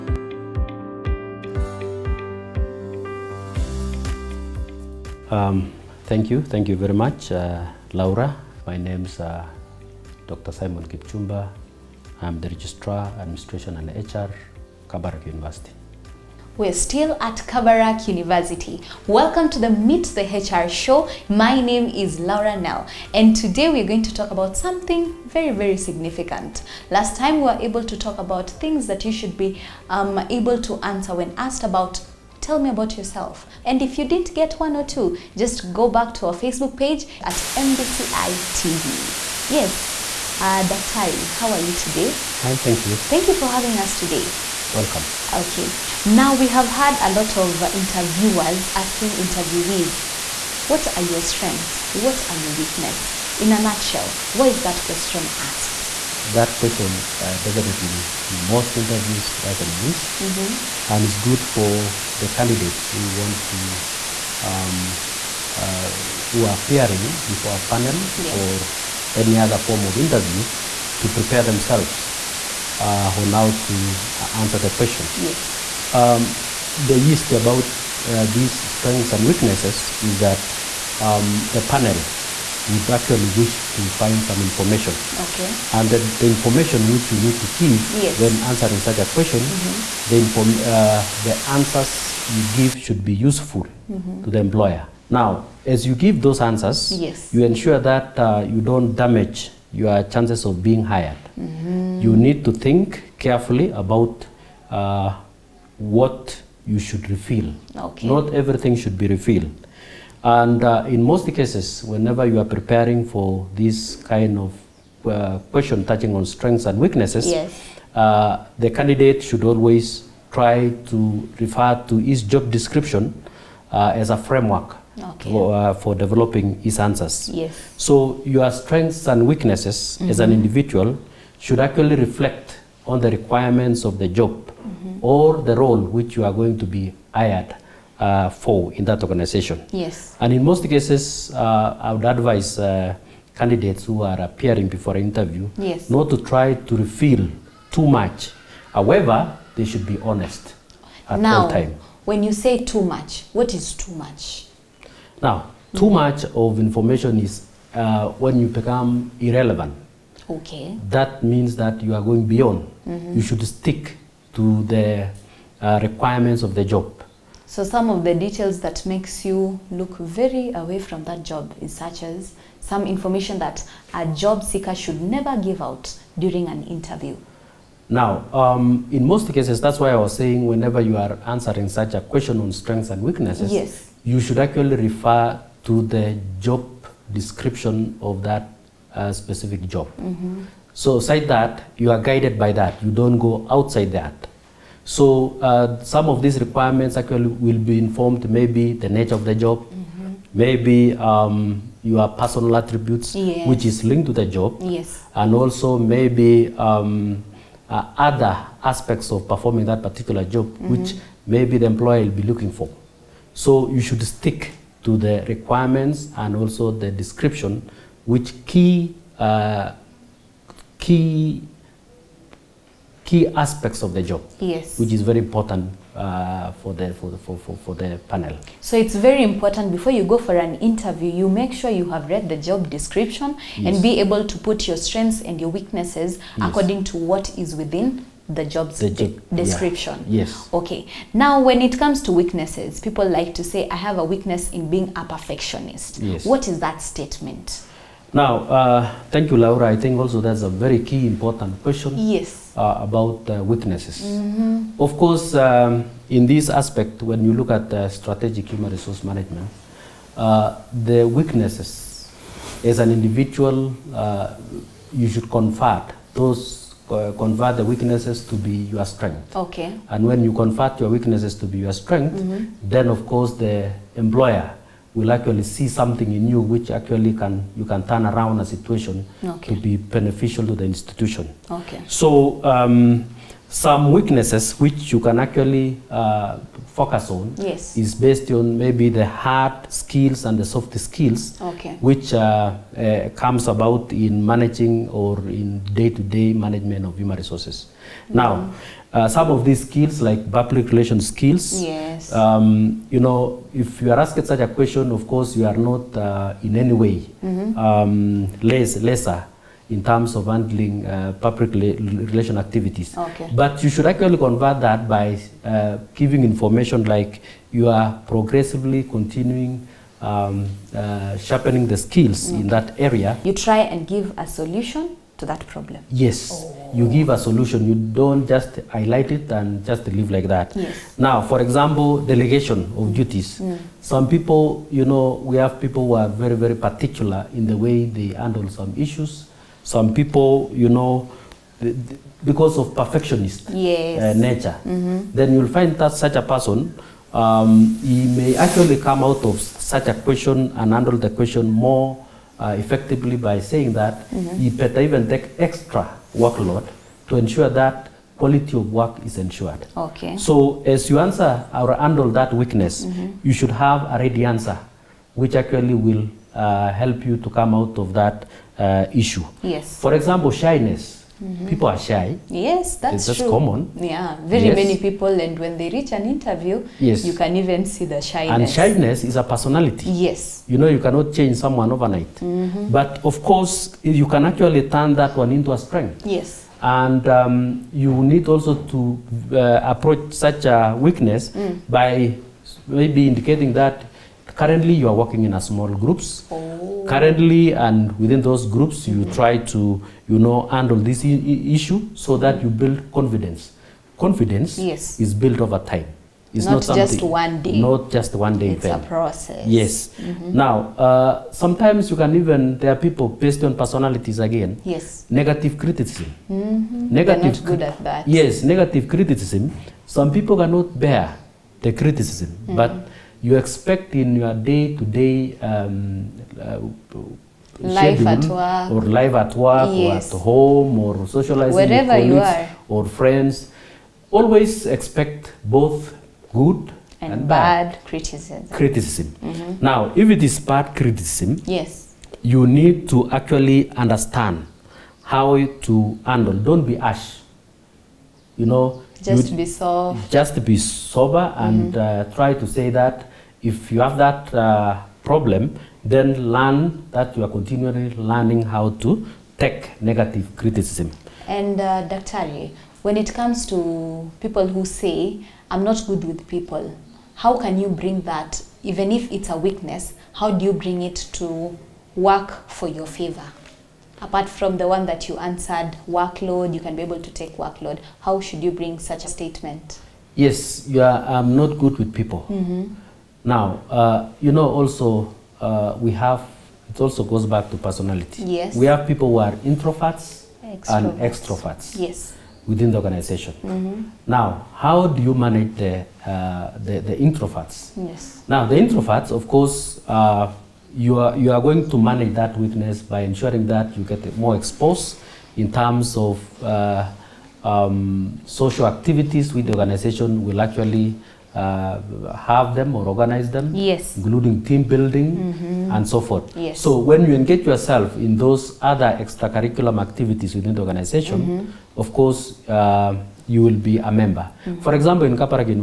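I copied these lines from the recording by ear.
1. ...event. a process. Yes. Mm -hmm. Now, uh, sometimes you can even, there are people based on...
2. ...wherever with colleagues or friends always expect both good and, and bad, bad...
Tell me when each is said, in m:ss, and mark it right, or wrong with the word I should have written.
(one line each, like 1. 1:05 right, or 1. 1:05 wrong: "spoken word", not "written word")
1. 6:48 right
2. 7:11 right.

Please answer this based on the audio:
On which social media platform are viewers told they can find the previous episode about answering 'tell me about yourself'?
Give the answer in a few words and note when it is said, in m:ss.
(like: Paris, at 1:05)
Facebook, at 0:36.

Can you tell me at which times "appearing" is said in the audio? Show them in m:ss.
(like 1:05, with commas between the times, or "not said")
1:06, 2:24.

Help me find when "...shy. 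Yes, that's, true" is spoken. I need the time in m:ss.
6:11.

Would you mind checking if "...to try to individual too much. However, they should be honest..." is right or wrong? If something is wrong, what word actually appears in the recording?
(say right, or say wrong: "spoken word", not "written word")
wrong: "reveal", not "individual".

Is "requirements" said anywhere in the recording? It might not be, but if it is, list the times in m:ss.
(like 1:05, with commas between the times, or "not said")
2:13, 2:45, 3:16, 3:35.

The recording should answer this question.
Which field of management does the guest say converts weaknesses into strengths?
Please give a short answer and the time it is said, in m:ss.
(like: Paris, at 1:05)
Strategic human resource management, at 4:17.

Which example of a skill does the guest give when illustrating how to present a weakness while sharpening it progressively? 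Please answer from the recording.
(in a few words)
Public relations skills.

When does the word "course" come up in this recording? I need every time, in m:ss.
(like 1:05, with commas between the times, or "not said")
4:14, 4:33, 5:05, 6:23, 8:19, 8:41.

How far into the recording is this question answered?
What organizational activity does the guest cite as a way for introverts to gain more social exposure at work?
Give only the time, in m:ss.
8:34.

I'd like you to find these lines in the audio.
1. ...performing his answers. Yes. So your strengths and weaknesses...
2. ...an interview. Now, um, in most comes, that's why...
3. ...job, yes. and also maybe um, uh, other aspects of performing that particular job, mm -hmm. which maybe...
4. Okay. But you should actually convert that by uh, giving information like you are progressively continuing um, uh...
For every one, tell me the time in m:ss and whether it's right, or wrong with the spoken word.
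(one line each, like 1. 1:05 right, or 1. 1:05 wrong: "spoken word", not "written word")
1. 2:05 wrong: "developing", not "performing"
2. 2:56 wrong: "cases", not "comes"
3. 3:24 right
4. 5:12 right.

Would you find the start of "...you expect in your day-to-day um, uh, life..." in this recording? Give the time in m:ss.
7:03.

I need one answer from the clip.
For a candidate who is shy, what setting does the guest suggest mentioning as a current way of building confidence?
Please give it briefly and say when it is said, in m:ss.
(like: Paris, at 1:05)
Small groups, at 6:35.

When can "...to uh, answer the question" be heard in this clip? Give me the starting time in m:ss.
1:13.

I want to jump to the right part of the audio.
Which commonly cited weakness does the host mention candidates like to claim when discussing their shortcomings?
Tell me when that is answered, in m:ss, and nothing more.
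4:04.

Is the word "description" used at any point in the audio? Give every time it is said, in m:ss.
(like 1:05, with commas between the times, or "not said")
2:02, 3:07, 3:36, 3:52, 3:59.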